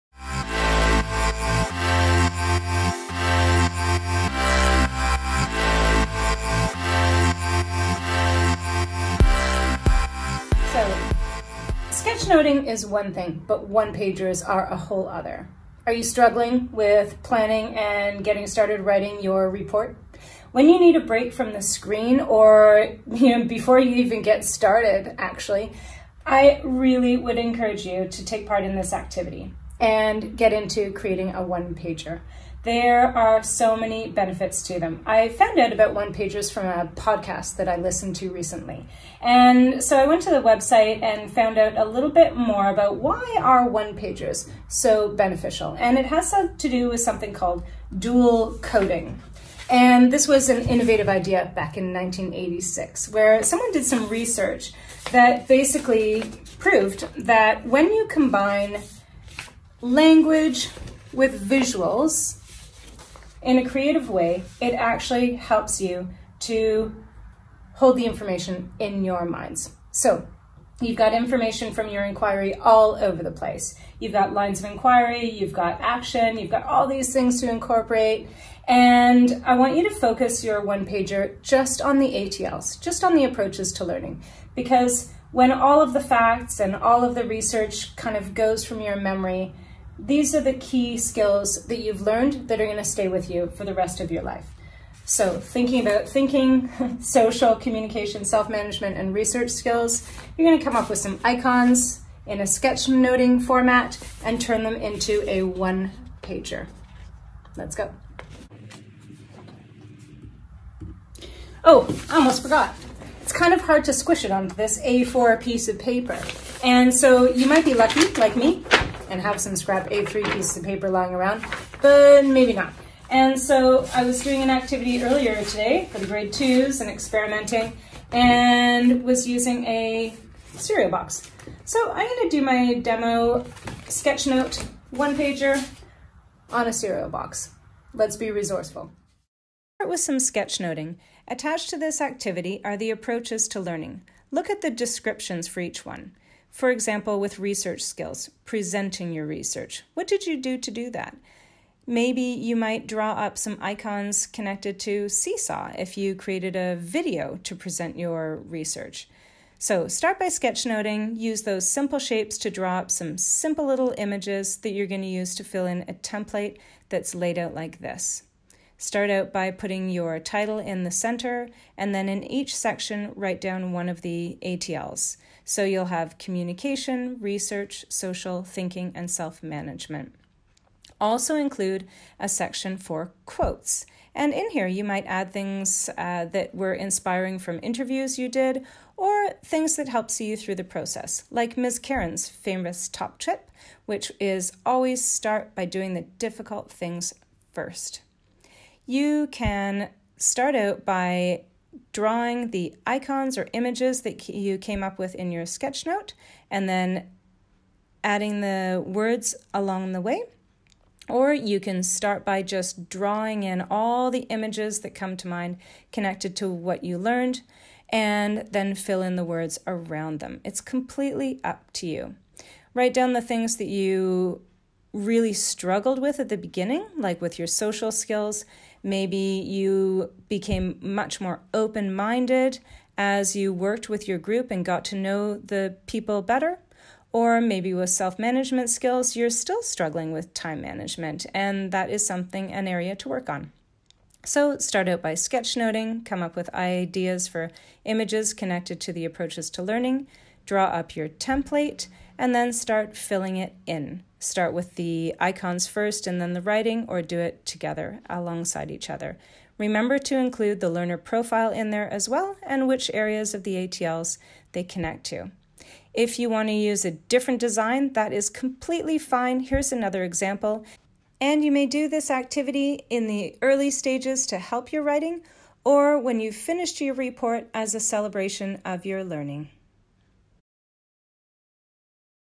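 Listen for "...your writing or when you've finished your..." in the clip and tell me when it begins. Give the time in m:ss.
4:34.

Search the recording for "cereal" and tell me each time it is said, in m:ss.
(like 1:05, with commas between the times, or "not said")
2:10, 2:16.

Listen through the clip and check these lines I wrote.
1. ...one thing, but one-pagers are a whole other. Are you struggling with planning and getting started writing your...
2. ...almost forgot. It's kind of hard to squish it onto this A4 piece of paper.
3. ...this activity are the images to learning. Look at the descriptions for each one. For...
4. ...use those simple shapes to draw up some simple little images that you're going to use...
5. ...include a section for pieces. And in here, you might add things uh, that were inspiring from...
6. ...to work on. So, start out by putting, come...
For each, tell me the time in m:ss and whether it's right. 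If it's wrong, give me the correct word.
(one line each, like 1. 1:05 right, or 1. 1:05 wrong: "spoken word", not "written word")
1. 0:12 right
2. 1:52 right
3. 2:21 wrong: "approaches", not "images"
4. 2:41 right
5. 3:01 wrong: "quotes", not "pieces"
6. 4:02 wrong: "sketchnoting", not "putting".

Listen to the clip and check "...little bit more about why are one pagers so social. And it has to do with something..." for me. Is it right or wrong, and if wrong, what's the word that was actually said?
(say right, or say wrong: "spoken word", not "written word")
wrong: "beneficial", not "social".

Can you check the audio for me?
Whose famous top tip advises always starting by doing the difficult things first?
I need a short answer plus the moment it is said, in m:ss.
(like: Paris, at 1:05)
Ms. Karen, at 3:11.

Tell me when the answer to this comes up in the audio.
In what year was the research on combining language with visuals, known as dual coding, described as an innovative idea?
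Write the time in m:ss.
0:51.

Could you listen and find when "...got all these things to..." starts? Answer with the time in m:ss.
1:16.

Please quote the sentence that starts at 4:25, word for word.
If you want to use a different design, that is completely fine.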